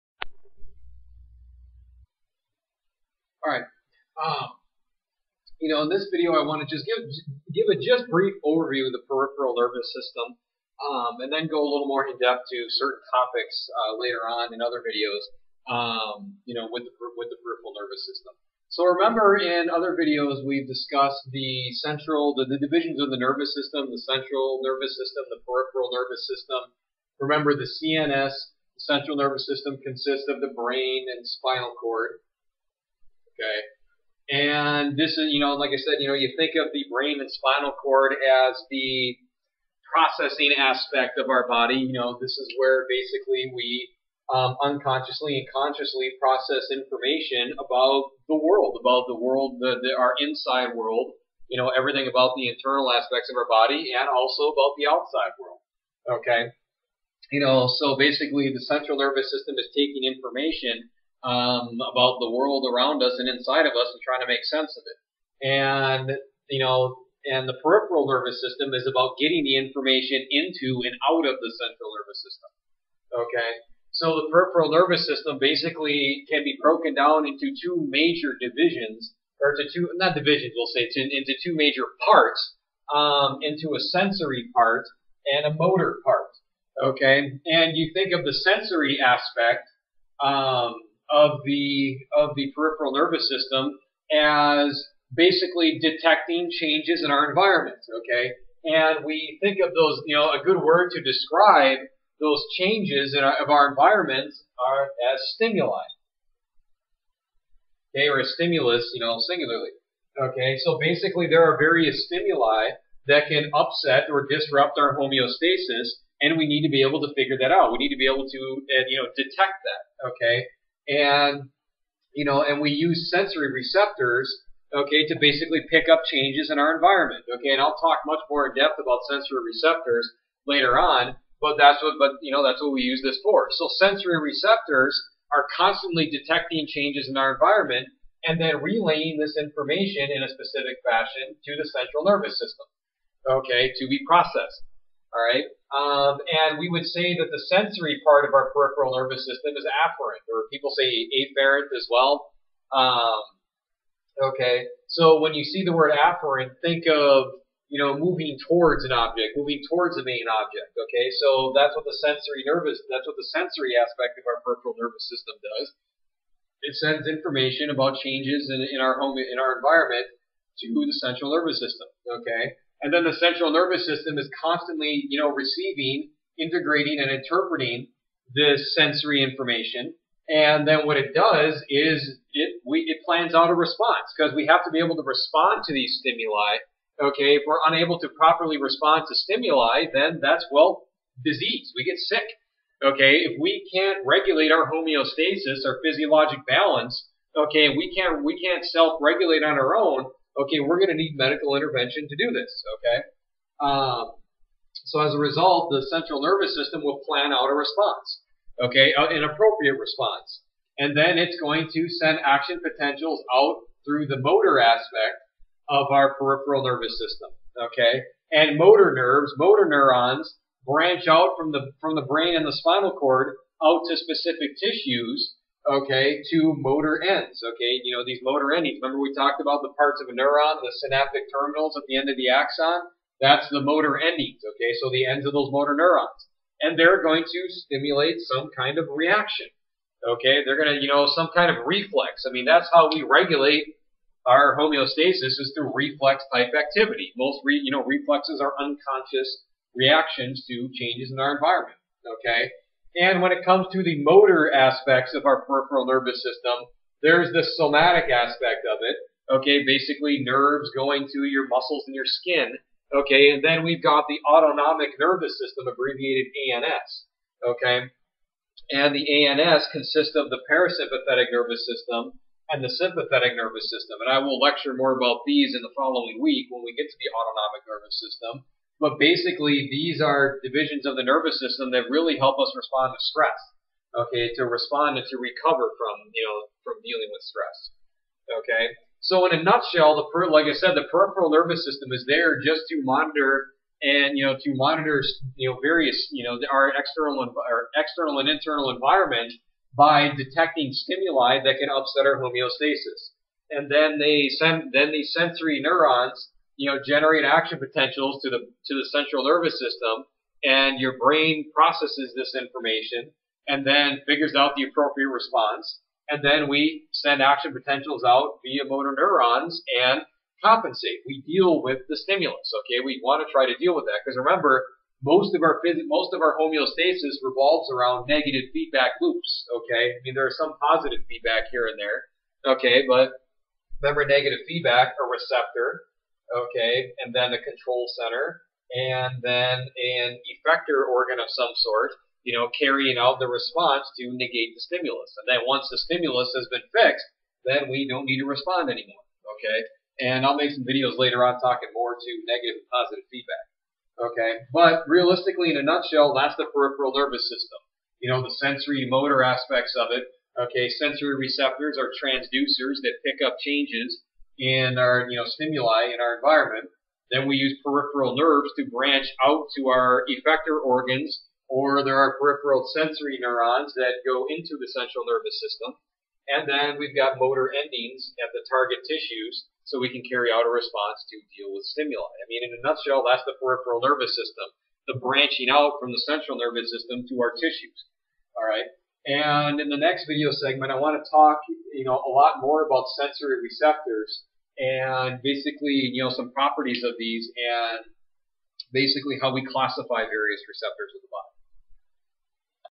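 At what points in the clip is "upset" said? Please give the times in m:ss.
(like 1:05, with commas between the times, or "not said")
1:53, 5:01.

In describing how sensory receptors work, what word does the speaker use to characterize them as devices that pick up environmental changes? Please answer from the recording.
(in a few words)
transducers.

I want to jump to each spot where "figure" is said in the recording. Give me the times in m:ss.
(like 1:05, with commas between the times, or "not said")
1:57, 5:14.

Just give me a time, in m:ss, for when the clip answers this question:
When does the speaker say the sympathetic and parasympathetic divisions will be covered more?
4:35.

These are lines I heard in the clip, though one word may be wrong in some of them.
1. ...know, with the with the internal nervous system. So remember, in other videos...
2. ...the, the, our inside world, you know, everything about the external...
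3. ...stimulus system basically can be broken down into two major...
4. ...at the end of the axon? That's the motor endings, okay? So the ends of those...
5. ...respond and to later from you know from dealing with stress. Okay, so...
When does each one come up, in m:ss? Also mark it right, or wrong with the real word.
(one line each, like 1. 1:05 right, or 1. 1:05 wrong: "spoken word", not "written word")
1. 0:16 wrong: "peripheral", not "internal"
2. 0:49 wrong: "internal", not "external"
3. 1:14 wrong: "nervous", not "stimulus"
4. 3:51 right
5. 4:44 wrong: "recover", not "later".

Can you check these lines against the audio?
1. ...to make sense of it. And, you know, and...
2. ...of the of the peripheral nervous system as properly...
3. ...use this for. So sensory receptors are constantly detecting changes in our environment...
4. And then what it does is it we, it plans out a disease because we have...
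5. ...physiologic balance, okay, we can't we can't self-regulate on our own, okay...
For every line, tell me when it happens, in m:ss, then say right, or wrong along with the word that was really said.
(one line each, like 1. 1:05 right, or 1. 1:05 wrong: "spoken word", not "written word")
1. 1:04 right
2. 1:31 wrong: "basically", not "properly"
3. 2:12 right
4. 3:00 wrong: "response", not "disease"
5. 3:15 right.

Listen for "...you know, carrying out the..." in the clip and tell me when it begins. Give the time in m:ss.
5:42.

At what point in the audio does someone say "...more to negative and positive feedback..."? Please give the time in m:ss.
5:51.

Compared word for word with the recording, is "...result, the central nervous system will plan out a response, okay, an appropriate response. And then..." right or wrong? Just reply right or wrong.
right.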